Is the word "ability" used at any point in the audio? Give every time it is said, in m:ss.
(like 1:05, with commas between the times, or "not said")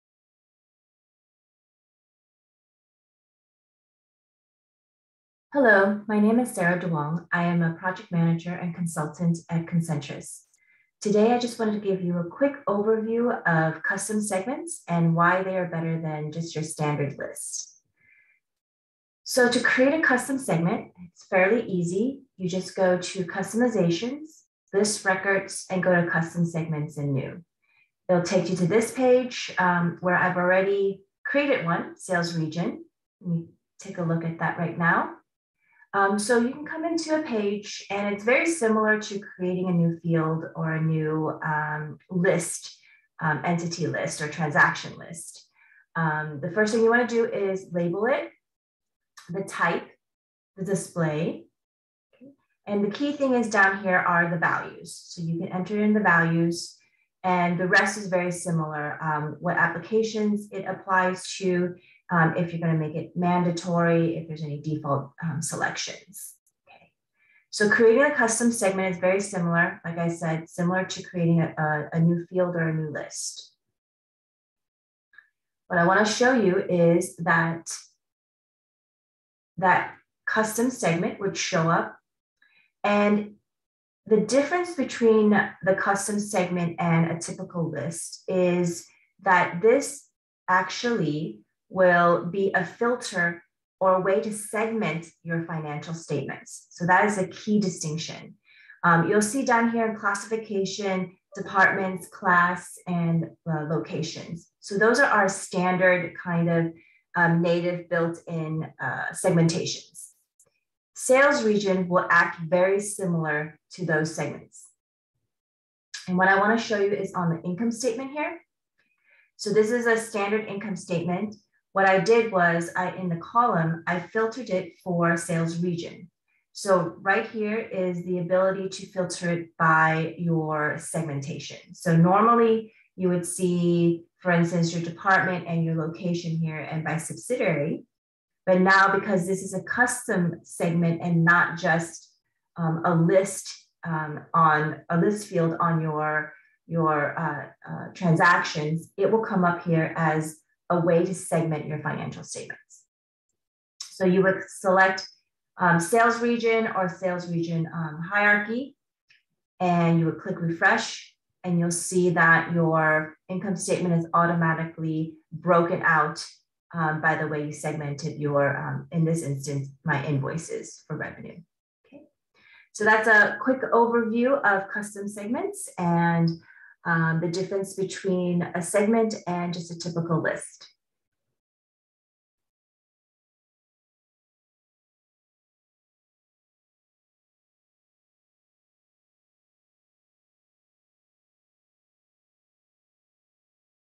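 2:08.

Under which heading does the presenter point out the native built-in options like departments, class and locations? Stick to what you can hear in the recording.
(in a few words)
Classification.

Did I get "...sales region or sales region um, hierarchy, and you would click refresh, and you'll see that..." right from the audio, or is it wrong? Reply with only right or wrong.
right.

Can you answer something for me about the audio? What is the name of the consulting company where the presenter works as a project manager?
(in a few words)
Concentrus.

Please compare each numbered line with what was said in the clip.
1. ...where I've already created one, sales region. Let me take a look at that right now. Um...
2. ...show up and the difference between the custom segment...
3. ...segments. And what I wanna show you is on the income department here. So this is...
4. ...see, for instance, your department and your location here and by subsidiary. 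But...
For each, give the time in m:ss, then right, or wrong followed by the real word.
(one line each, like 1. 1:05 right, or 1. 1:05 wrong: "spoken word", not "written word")
1. 0:29 right
2. 1:21 right
3. 1:54 wrong: "statement", not "department"
4. 2:13 right.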